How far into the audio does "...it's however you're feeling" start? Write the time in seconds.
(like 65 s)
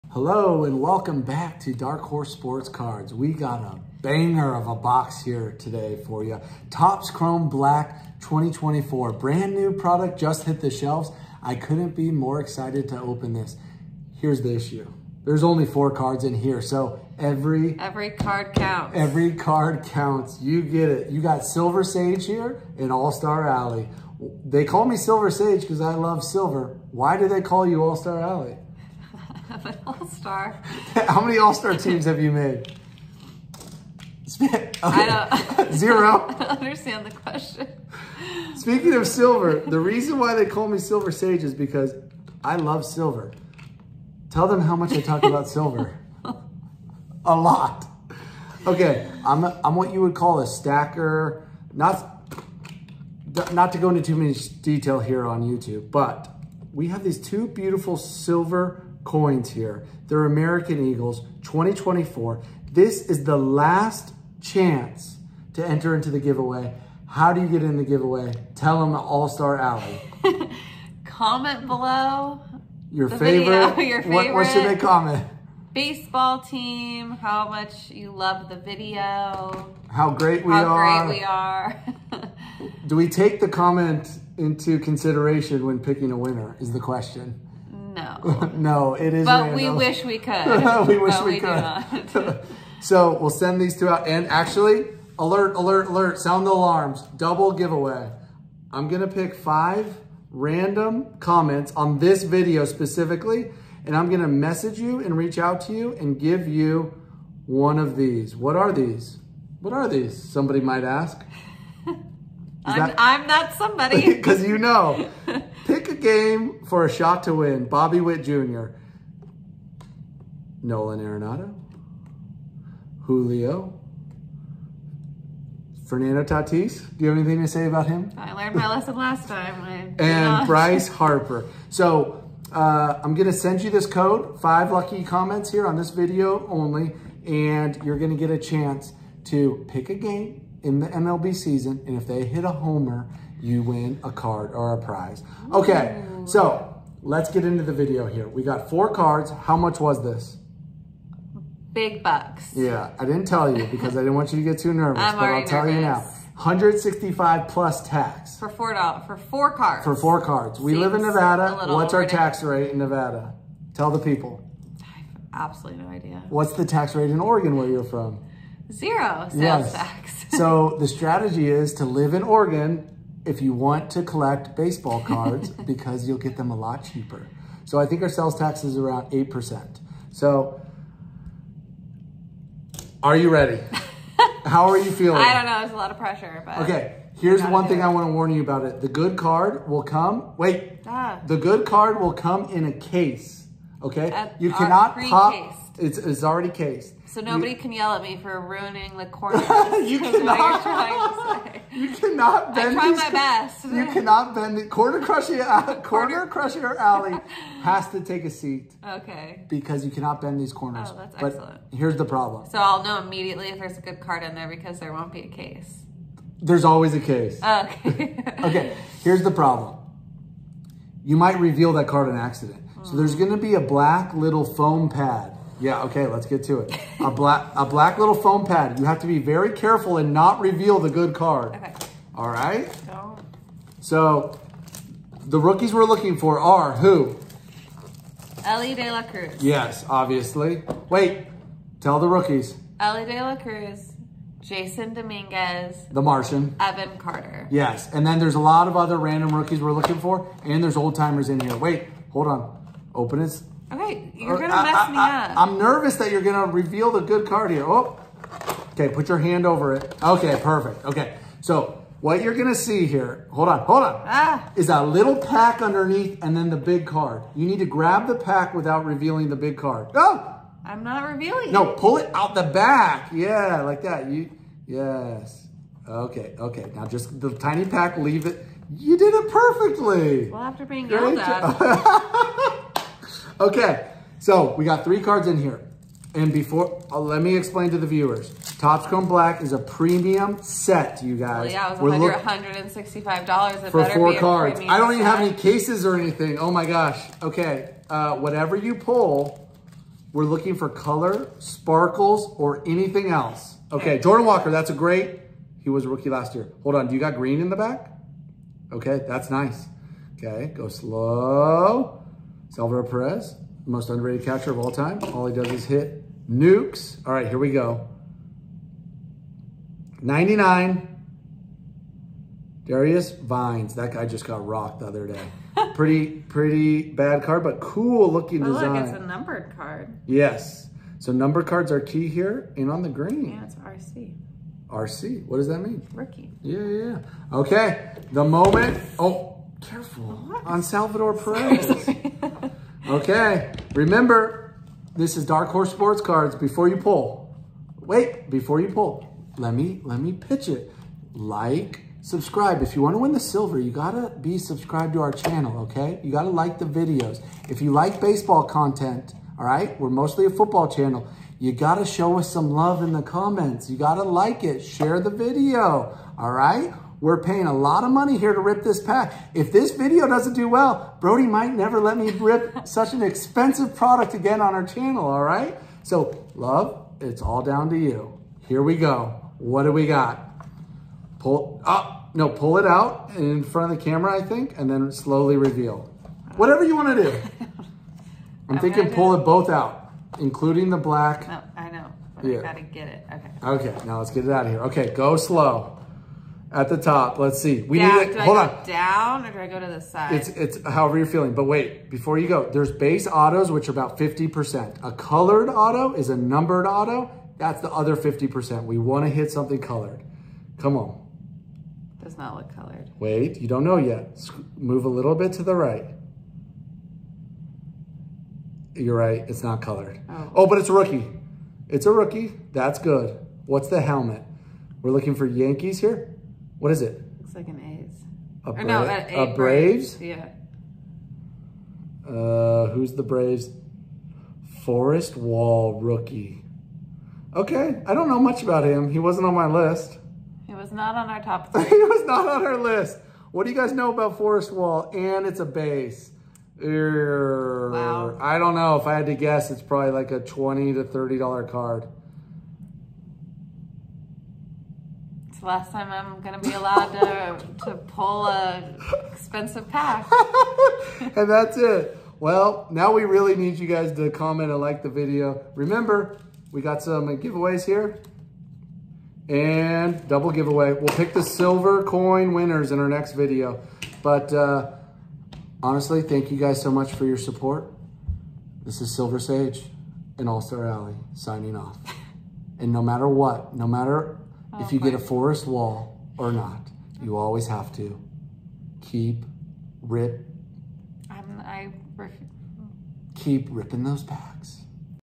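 400 s.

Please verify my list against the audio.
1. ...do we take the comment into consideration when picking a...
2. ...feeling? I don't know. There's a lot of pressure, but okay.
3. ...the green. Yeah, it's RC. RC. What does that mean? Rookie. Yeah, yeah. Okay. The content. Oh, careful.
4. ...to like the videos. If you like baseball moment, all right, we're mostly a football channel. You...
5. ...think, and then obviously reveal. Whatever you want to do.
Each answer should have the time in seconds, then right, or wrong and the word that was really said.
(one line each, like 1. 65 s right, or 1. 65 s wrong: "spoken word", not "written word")
1. 82 s right
2. 184 s right
3. 332 s wrong: "moment", not "content"
4. 356 s wrong: "content", not "moment"
5. 384 s wrong: "slowly", not "obviously".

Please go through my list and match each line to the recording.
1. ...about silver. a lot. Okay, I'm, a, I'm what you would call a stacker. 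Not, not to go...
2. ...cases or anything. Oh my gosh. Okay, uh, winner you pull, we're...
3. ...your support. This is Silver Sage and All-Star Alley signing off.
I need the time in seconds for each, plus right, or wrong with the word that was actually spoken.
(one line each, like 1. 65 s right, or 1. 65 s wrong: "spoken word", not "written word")
1. 45 s right
2. 295 s wrong: "whatever", not "winner"
3. 477 s right.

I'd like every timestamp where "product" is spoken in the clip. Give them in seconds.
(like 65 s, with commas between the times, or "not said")
9 s, 373 s.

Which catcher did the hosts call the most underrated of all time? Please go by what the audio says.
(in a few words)
Salvador Perez.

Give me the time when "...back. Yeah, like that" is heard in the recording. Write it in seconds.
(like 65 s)
272 s.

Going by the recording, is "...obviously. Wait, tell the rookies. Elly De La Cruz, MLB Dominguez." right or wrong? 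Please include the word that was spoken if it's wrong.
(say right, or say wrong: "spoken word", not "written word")
wrong: "Jasson", not "MLB".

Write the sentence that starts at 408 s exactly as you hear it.
We want to hit something colored.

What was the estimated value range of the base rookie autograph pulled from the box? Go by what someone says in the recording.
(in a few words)
$20 to $30.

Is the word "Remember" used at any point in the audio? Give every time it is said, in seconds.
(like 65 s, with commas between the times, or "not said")
343 s, 465 s.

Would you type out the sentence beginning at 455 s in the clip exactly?
It's the last time I'm going to be allowed to, to pull a expensive pack.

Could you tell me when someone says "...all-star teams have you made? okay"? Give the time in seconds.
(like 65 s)
31 s.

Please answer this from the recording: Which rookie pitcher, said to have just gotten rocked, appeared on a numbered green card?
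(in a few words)
Darius Vines.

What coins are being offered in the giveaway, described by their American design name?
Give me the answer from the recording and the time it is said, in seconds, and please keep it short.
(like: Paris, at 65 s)
American Eagles, at 60 s.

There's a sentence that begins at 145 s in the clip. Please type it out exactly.
Okay, so let's get into the video here.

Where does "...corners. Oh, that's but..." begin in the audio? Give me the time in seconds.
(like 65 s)
210 s.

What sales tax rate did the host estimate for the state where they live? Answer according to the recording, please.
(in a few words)
8%.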